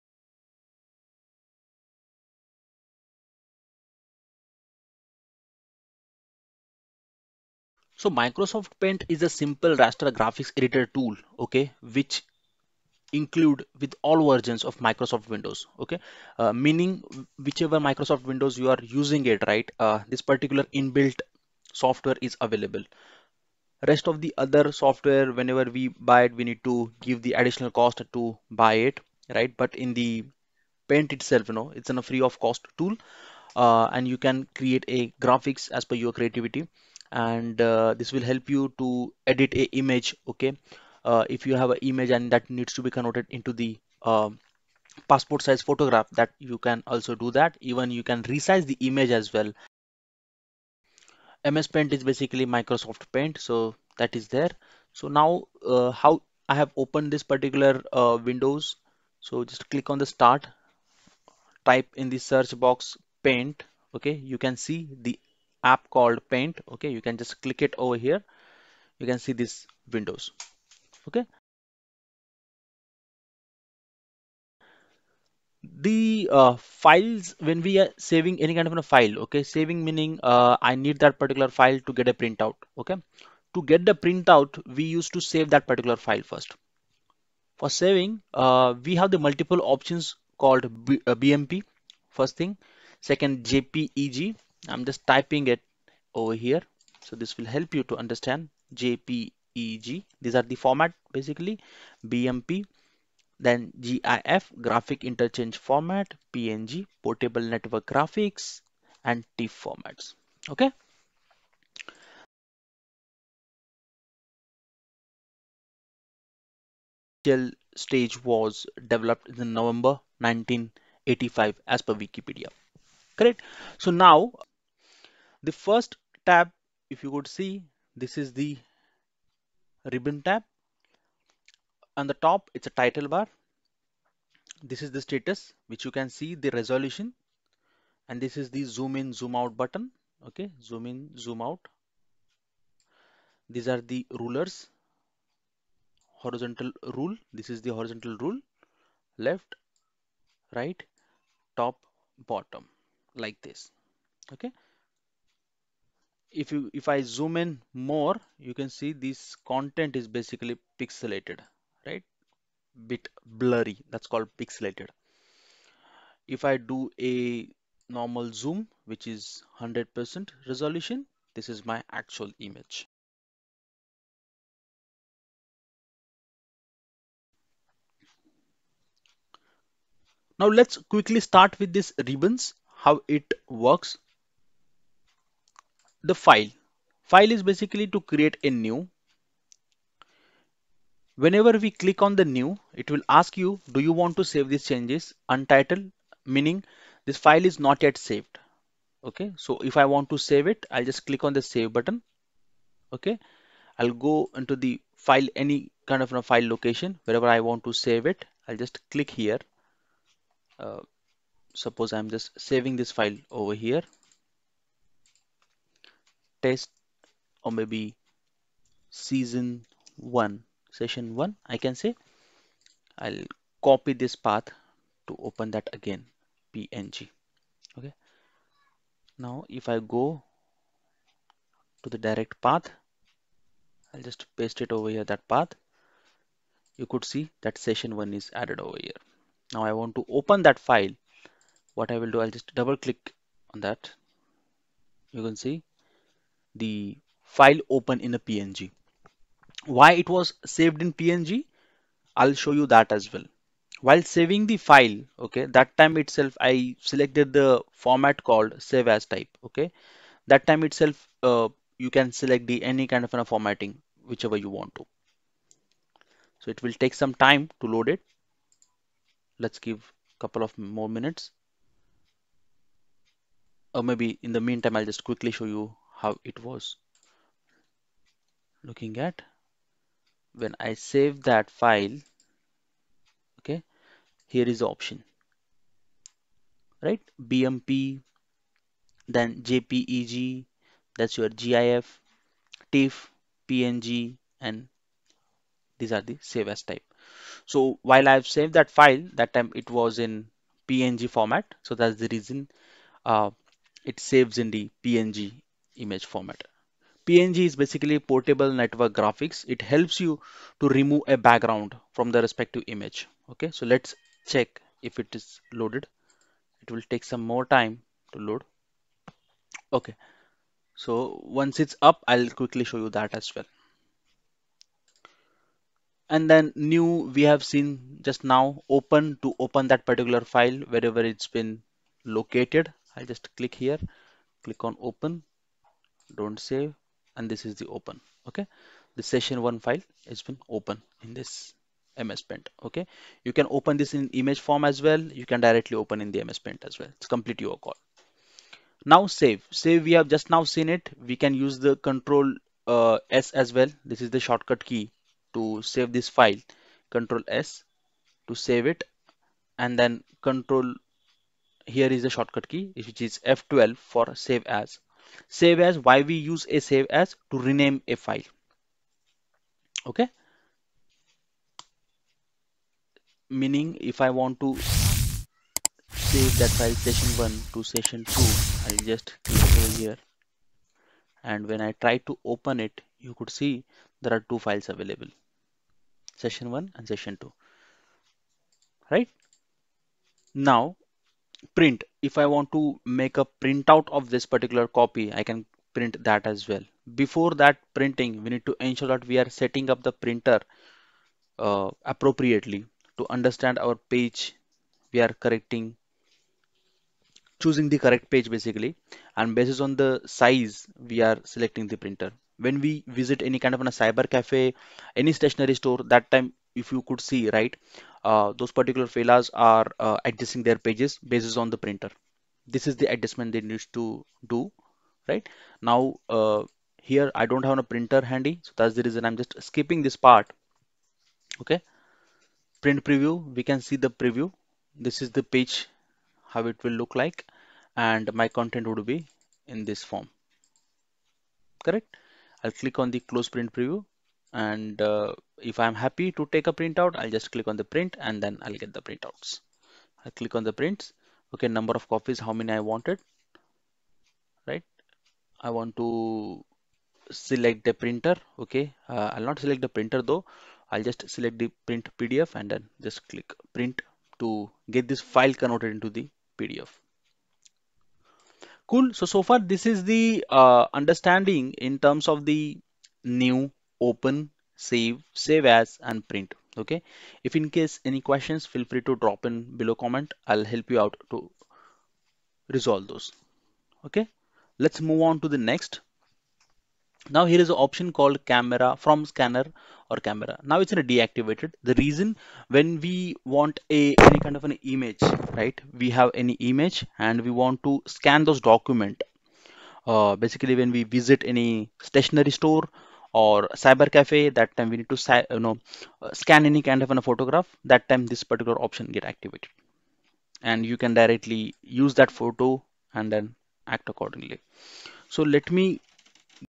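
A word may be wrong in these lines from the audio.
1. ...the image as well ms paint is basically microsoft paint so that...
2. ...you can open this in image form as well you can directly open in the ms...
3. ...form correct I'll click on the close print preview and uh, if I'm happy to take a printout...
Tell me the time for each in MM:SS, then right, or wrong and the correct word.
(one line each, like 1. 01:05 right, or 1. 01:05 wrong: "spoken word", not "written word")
1. 00:48 right
2. 05:43 right
3. 07:19 right.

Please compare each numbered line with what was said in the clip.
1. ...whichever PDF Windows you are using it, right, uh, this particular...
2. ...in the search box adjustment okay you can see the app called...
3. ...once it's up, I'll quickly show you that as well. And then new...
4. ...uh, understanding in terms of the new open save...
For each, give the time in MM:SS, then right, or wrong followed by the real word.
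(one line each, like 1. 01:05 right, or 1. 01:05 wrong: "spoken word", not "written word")
1. 00:17 wrong: "Microsoft", not "PDF"
2. 01:01 wrong: "paint", not "adjustment"
3. 05:21 right
4. 07:50 right.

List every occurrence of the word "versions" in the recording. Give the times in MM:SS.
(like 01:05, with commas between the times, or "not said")
00:14.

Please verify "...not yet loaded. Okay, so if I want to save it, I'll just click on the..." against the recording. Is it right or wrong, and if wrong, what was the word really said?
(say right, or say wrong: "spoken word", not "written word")
wrong: "saved", not "loaded".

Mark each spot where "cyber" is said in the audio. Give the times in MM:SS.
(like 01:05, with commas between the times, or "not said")
06:53, 08:23.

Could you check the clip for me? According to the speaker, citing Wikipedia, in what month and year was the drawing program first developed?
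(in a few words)
November 1985.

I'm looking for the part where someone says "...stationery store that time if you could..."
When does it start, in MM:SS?
06:55.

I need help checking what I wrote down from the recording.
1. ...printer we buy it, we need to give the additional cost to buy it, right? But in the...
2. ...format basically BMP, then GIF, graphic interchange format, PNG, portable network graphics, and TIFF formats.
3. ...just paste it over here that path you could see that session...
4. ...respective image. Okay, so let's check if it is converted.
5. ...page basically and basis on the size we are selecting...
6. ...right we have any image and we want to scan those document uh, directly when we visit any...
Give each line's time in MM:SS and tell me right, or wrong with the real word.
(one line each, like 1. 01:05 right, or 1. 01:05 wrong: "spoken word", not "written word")
1. 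00:25 wrong: "whenever", not "printer"
2. 01:40 right
3. 03:54 right
4. 05:12 wrong: "loaded", not "converted"
5. 06:48 right
6. 08:15 wrong: "basically", not "directly".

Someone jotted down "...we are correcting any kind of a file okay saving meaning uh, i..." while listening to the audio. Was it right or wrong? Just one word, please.
wrong.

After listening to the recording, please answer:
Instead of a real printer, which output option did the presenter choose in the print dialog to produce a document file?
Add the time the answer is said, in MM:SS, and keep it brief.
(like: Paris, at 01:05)
Print PDF, at 07:41.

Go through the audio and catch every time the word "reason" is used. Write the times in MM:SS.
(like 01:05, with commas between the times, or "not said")
05:02, 07:08, 08:11.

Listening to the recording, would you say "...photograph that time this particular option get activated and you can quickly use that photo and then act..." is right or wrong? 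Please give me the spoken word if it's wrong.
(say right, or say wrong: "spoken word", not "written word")
wrong: "directly", not "quickly".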